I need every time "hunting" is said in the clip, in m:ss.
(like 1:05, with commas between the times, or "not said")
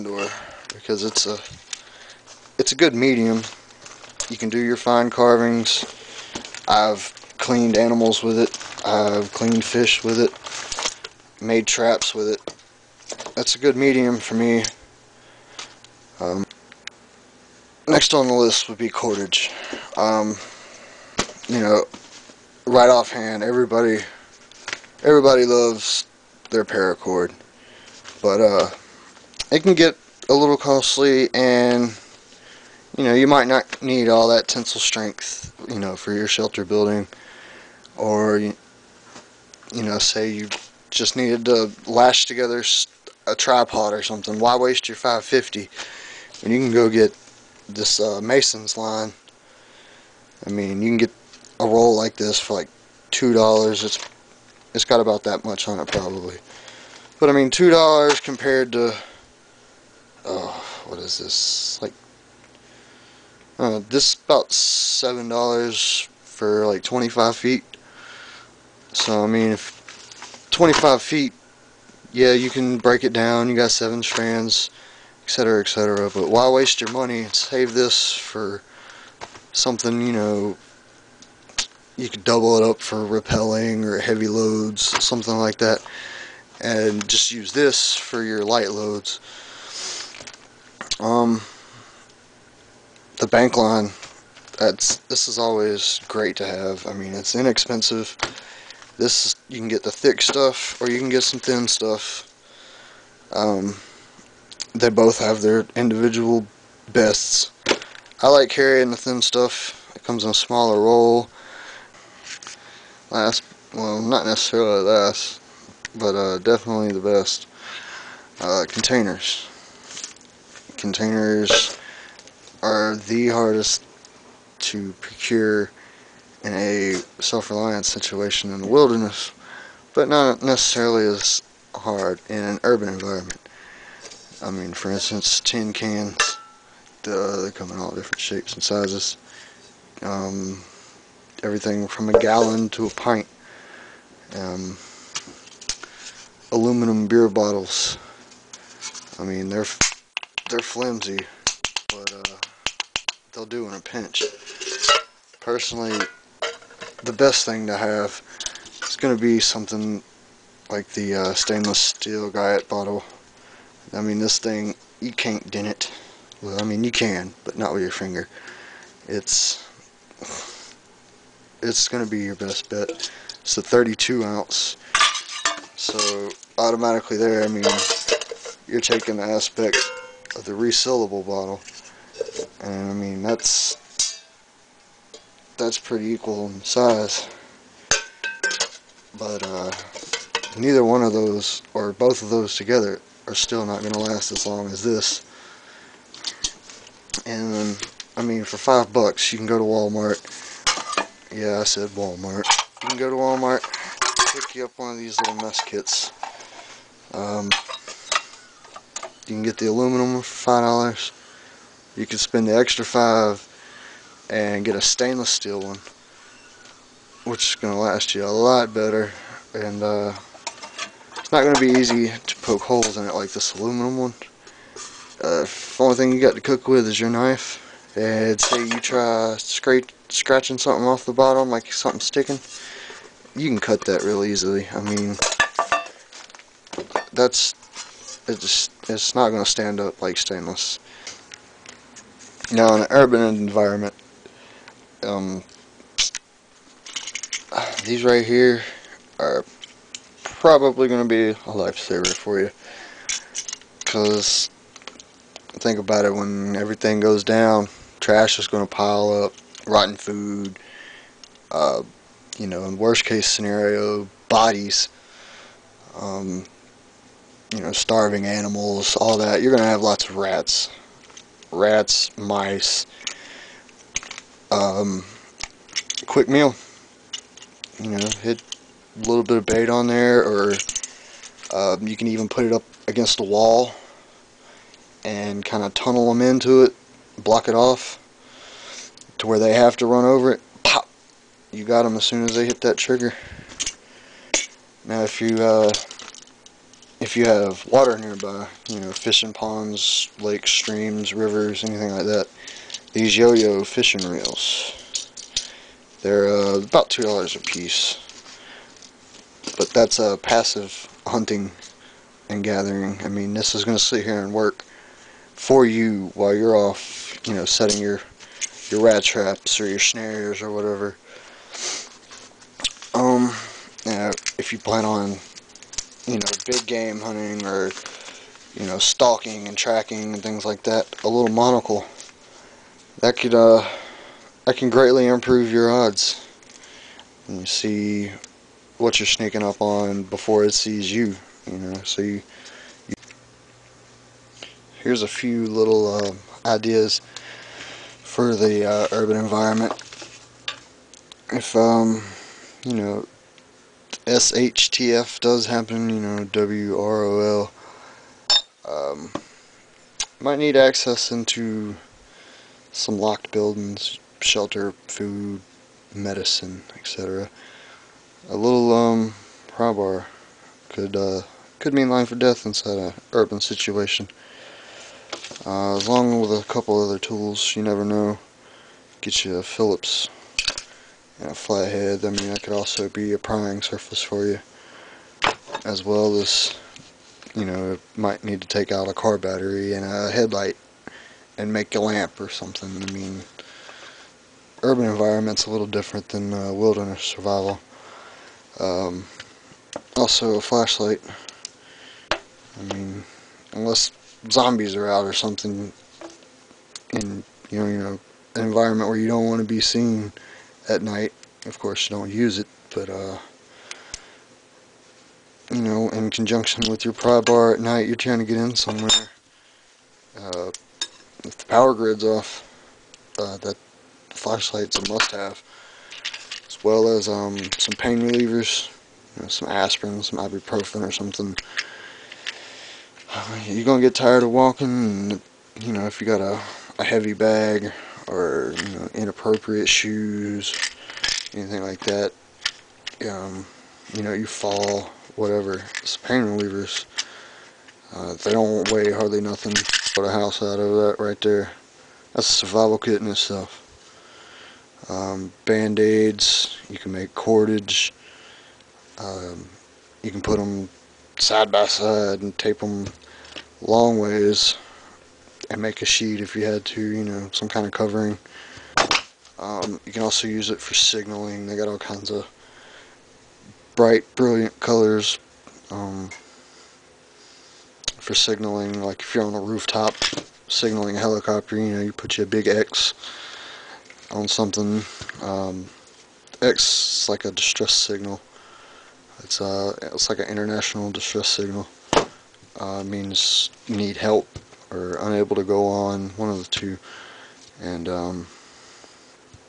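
5:11, 5:27.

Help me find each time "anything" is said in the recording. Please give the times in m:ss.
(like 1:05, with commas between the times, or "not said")
5:01, 7:21.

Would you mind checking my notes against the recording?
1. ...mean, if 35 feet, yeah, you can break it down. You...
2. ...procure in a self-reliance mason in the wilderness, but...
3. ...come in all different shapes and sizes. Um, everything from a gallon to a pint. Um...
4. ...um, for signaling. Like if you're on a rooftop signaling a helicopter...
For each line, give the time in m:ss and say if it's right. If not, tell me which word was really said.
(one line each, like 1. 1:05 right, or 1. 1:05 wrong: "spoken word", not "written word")
1. 1:09 wrong: "25", not "35"
2. 2:05 wrong: "situation", not "mason"
3. 2:17 right
4. 7:55 right.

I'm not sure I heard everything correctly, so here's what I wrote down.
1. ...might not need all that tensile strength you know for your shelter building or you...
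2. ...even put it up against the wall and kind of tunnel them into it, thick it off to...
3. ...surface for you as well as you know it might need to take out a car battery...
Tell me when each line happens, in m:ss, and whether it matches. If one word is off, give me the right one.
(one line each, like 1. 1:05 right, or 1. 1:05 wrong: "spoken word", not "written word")
1. 0:33 right
2. 4:42 wrong: "block", not "thick"
3. 6:23 right.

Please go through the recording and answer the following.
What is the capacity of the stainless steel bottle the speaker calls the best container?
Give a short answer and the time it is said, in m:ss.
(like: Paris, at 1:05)
32 ounces, at 2:53.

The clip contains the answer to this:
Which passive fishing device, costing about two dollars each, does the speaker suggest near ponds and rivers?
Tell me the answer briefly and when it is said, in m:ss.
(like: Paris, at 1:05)
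yo-yo fishing reels, at 5:03.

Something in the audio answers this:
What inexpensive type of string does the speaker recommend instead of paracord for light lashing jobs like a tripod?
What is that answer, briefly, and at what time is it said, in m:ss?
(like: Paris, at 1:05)
mason's line, at 0:48.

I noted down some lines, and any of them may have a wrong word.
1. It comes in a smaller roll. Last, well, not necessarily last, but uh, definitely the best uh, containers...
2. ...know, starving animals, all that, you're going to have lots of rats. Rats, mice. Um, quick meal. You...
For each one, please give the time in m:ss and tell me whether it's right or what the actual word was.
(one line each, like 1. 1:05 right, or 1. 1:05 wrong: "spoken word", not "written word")
1. 1:49 right
2. 4:27 right.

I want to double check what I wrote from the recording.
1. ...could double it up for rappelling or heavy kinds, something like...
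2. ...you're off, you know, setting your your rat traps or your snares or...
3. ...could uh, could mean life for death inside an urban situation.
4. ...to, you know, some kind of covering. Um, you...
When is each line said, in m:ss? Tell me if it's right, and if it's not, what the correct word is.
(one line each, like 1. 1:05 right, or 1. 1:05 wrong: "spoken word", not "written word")
1. 1:22 wrong: "loads", not "kinds"
2. 5:16 right
3. 6:10 right
4. 7:46 right.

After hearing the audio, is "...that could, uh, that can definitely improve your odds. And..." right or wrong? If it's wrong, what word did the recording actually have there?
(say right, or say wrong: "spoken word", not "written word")
wrong: "greatly", not "definitely".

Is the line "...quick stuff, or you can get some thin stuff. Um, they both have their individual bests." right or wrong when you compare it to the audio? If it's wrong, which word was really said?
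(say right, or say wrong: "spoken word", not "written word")
wrong: "thick", not "quick".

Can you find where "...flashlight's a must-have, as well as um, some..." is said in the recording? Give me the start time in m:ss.
7:04.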